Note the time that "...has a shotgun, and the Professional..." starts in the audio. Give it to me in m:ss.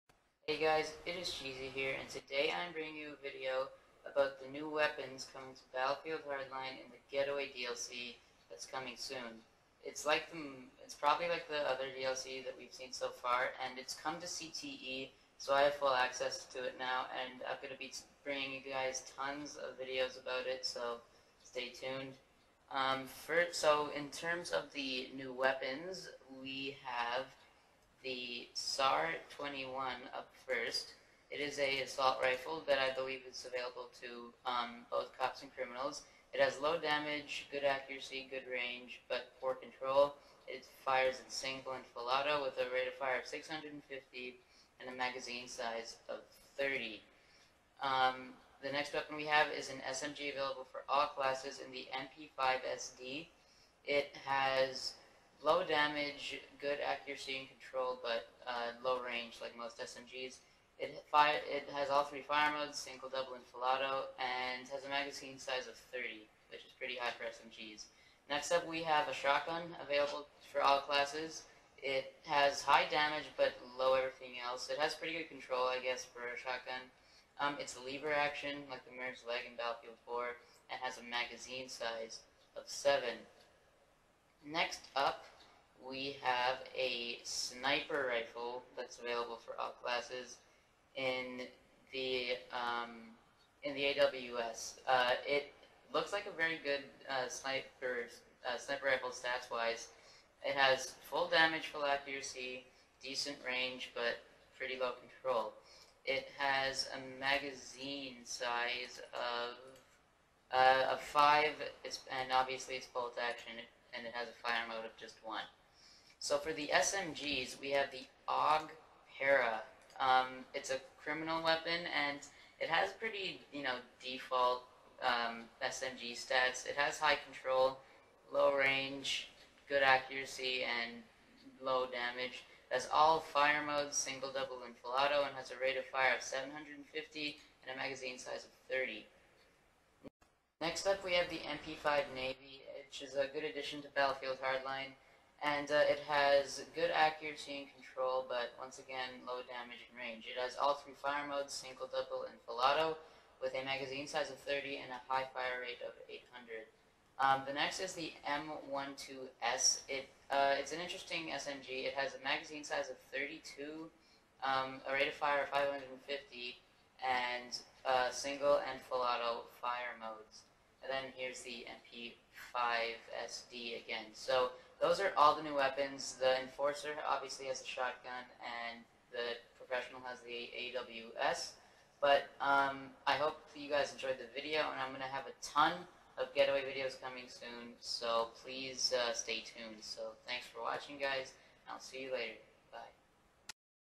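2:57.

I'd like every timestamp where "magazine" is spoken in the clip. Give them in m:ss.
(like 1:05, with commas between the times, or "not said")
0:44, 1:04, 1:21, 1:47, 2:17, 2:33, 2:42.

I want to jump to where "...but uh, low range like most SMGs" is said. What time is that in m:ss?
0:58.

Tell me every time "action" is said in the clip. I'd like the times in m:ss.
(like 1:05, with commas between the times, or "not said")
1:18, 1:53.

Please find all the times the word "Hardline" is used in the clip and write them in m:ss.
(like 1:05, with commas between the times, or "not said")
0:06, 2:24.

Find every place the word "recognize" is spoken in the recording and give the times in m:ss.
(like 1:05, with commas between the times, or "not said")
not said.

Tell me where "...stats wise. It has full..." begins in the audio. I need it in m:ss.
1:39.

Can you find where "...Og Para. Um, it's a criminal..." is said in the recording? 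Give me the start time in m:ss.
1:58.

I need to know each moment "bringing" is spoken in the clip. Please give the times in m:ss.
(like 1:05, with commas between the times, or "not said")
0:02, 0:18.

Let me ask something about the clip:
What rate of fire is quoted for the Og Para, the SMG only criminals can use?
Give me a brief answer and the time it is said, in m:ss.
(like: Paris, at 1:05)
750, at 2:16.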